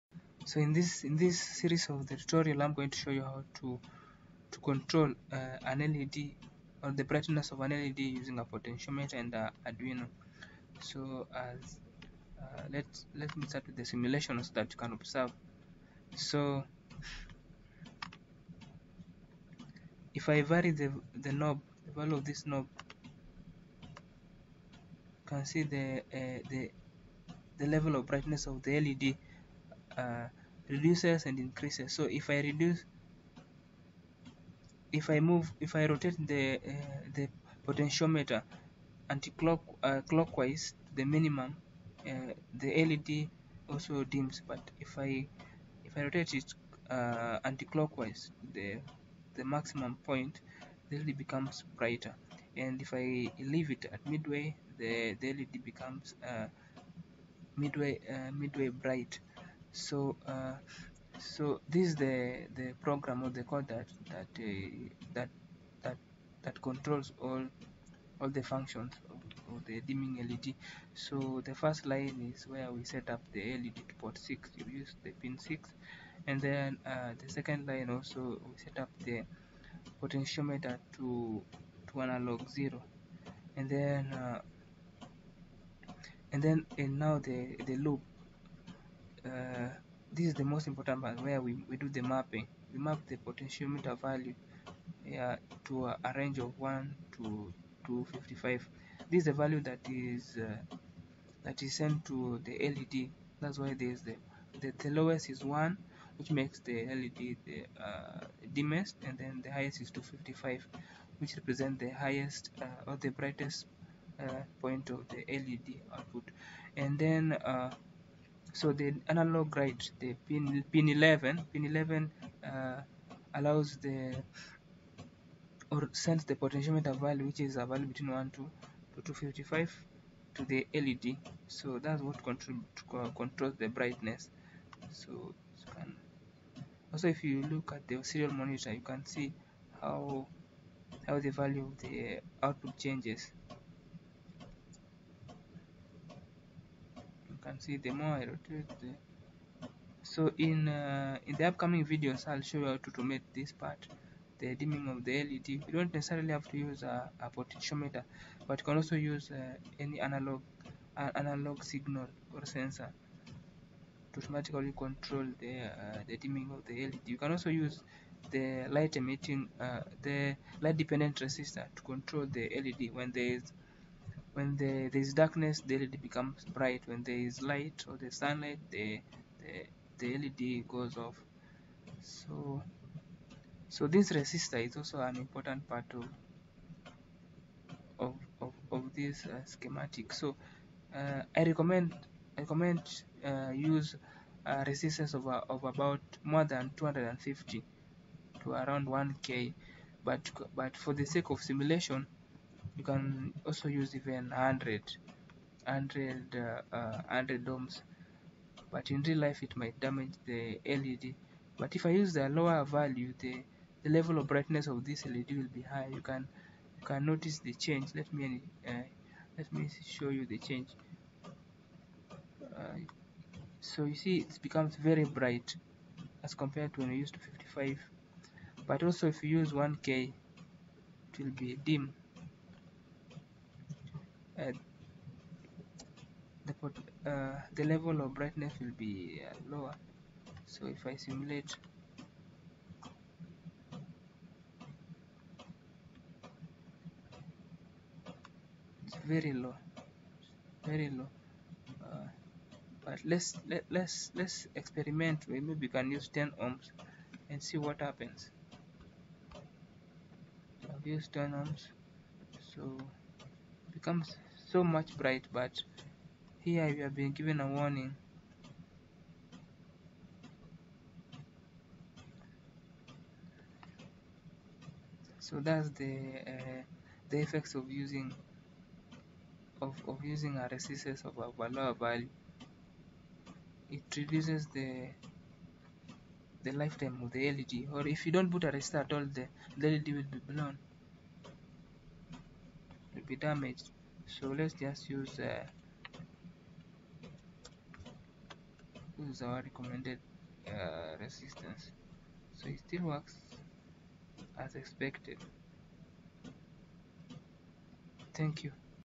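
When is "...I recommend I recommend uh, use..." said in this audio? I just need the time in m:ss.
3:11.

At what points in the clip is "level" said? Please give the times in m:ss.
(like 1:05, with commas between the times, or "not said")
0:27, 3:33, 3:57.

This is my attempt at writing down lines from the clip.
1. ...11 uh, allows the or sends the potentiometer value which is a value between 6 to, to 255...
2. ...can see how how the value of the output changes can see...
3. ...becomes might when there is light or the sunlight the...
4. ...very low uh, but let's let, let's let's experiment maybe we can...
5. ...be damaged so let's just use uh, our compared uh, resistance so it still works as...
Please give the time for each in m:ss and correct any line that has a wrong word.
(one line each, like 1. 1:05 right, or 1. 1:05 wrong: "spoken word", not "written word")
1. 2:01 wrong: "1", not "6"
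2. 2:18 right
3. 2:56 wrong: "bright", not "might"
4. 4:10 right
5. 4:53 wrong: "recommended", not "compared".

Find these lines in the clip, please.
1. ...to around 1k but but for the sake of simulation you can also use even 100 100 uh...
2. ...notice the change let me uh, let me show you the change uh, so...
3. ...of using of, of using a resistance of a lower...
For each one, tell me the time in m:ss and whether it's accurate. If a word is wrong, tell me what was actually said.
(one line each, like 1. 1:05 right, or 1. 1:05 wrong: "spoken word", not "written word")
1. 3:18 right
2. 3:37 right
3. 4:37 right.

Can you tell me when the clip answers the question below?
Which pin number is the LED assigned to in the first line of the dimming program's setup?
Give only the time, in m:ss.
1:13.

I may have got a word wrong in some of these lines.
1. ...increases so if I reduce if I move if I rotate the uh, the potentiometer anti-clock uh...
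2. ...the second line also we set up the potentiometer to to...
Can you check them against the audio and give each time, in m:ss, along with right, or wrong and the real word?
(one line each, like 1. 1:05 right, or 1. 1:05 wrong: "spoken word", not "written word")
1. 0:31 right
2. 1:17 right.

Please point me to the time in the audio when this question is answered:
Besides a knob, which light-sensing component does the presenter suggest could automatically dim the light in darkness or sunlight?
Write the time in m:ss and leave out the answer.
2:50.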